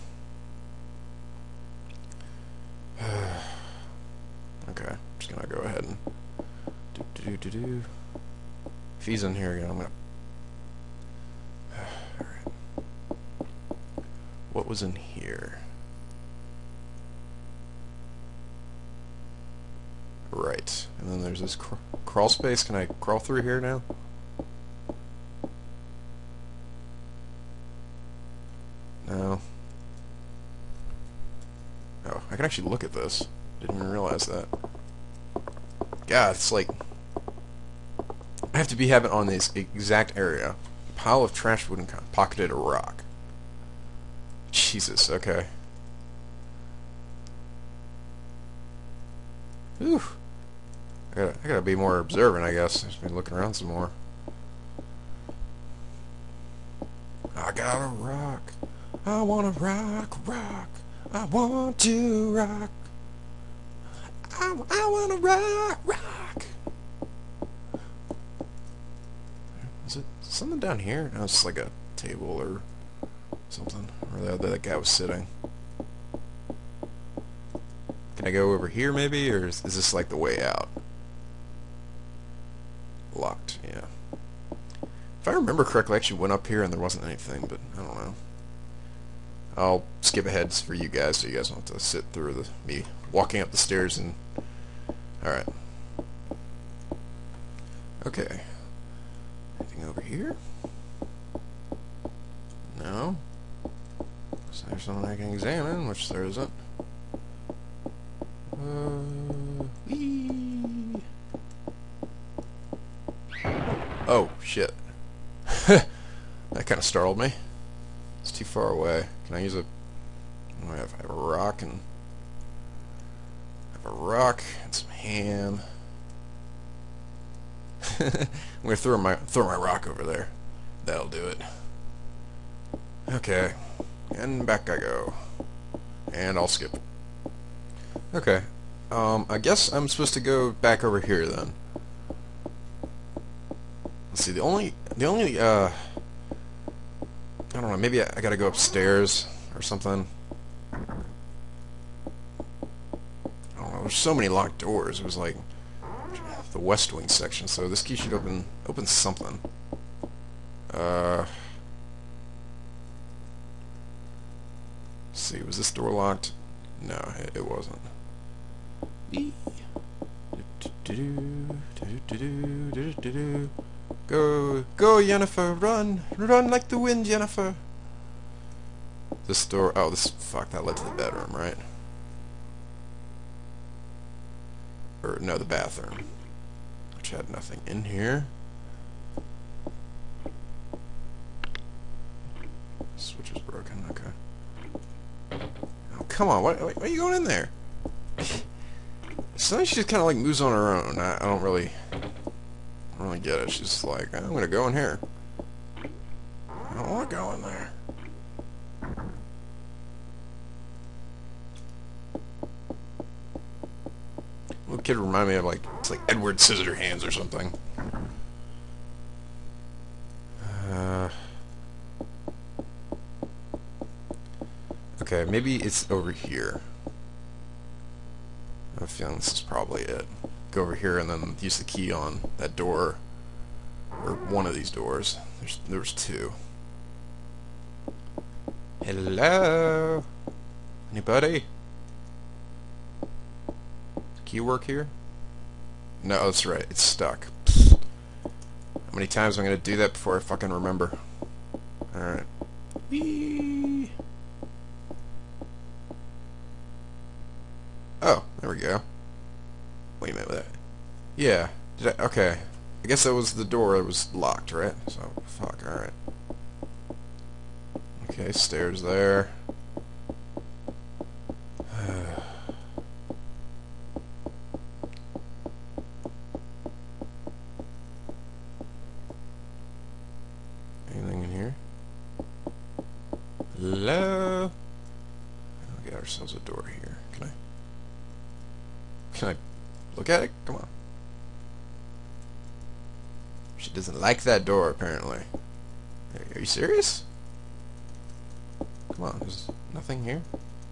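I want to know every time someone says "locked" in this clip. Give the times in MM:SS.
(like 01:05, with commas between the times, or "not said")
01:23, 02:34, 02:45, 04:24.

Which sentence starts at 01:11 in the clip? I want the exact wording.
No, it's like a table or something.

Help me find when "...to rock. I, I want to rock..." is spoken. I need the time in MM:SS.
01:01.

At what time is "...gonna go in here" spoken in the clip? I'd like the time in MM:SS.
03:24.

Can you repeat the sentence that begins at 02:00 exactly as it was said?
Oh, I, have, I have a rock and...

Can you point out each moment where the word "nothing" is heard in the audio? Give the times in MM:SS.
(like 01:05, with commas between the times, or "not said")
03:07, 04:59.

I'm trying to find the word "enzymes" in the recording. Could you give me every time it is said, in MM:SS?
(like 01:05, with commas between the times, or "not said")
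not said.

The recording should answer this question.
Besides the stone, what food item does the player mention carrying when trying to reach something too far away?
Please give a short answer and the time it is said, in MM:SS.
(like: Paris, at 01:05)
ham, at 02:04.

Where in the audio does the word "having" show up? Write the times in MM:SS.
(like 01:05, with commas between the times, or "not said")
00:38.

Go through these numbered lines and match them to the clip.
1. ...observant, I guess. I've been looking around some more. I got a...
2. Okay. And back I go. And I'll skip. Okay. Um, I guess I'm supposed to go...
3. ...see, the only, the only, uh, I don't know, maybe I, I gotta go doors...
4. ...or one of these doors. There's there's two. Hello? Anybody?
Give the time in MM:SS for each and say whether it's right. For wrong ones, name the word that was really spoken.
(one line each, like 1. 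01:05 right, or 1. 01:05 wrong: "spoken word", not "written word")
1. 00:51 right
2. 02:13 right
3. 02:24 wrong: "upstairs", not "doors"
4. 03:54 right.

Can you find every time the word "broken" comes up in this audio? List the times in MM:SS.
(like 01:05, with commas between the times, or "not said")
03:13.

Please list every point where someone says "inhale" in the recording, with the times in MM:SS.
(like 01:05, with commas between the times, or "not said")
not said.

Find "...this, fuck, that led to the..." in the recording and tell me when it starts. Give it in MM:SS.
02:59.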